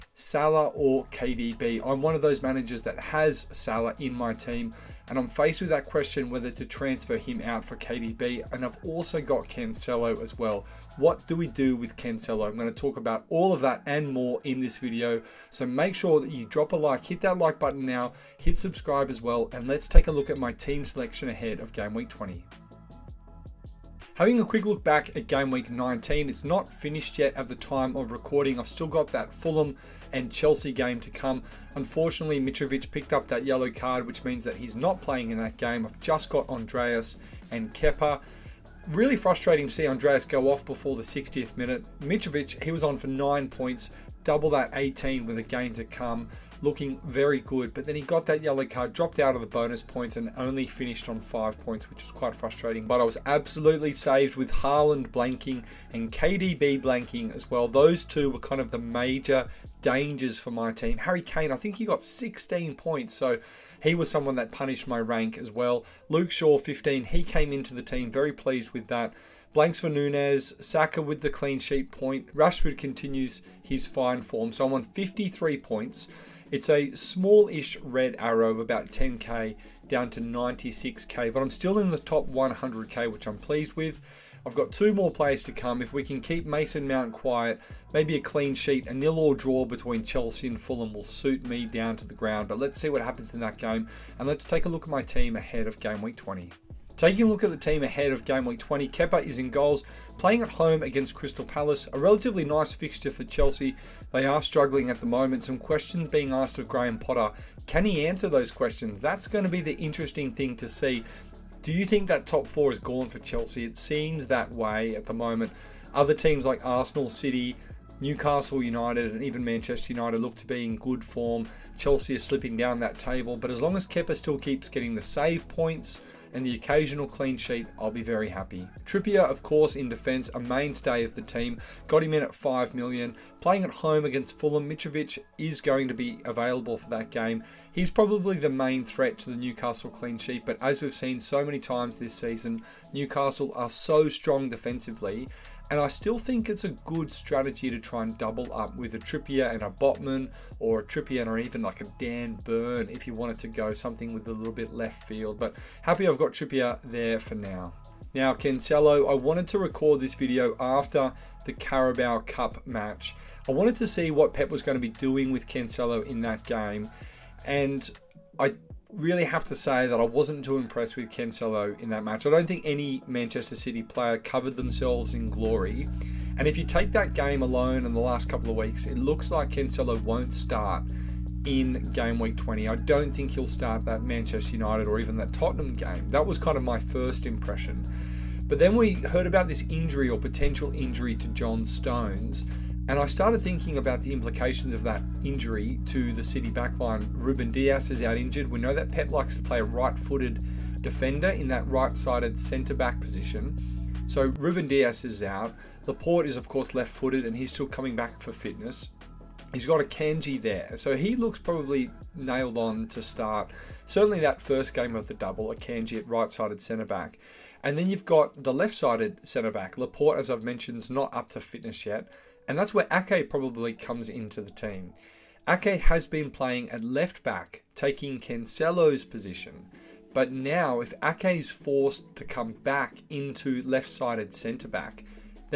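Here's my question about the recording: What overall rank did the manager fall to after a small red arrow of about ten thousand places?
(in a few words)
96k.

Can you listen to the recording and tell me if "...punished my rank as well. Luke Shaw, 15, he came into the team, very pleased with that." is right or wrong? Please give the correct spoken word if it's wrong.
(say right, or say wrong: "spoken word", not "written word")
right.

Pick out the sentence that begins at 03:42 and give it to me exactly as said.
And that's where Ake probably comes into the team.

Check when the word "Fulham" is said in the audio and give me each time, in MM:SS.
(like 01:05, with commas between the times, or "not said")
00:29, 01:30, 02:14.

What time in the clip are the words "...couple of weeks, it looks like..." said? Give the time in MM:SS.
02:58.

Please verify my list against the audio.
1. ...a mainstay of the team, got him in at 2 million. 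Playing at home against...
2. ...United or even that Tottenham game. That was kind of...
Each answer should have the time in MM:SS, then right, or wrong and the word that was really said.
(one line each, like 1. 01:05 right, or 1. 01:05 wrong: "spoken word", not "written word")
1. 02:10 wrong: "5", not "2"
2. 03:04 right.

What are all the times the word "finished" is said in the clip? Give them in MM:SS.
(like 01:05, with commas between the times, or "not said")
00:26, 00:50.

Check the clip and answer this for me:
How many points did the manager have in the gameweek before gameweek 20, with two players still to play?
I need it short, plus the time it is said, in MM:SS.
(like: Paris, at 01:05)
53, at 01:14.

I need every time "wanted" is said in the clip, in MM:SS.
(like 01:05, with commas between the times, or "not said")
02:33, 02:39, 02:43.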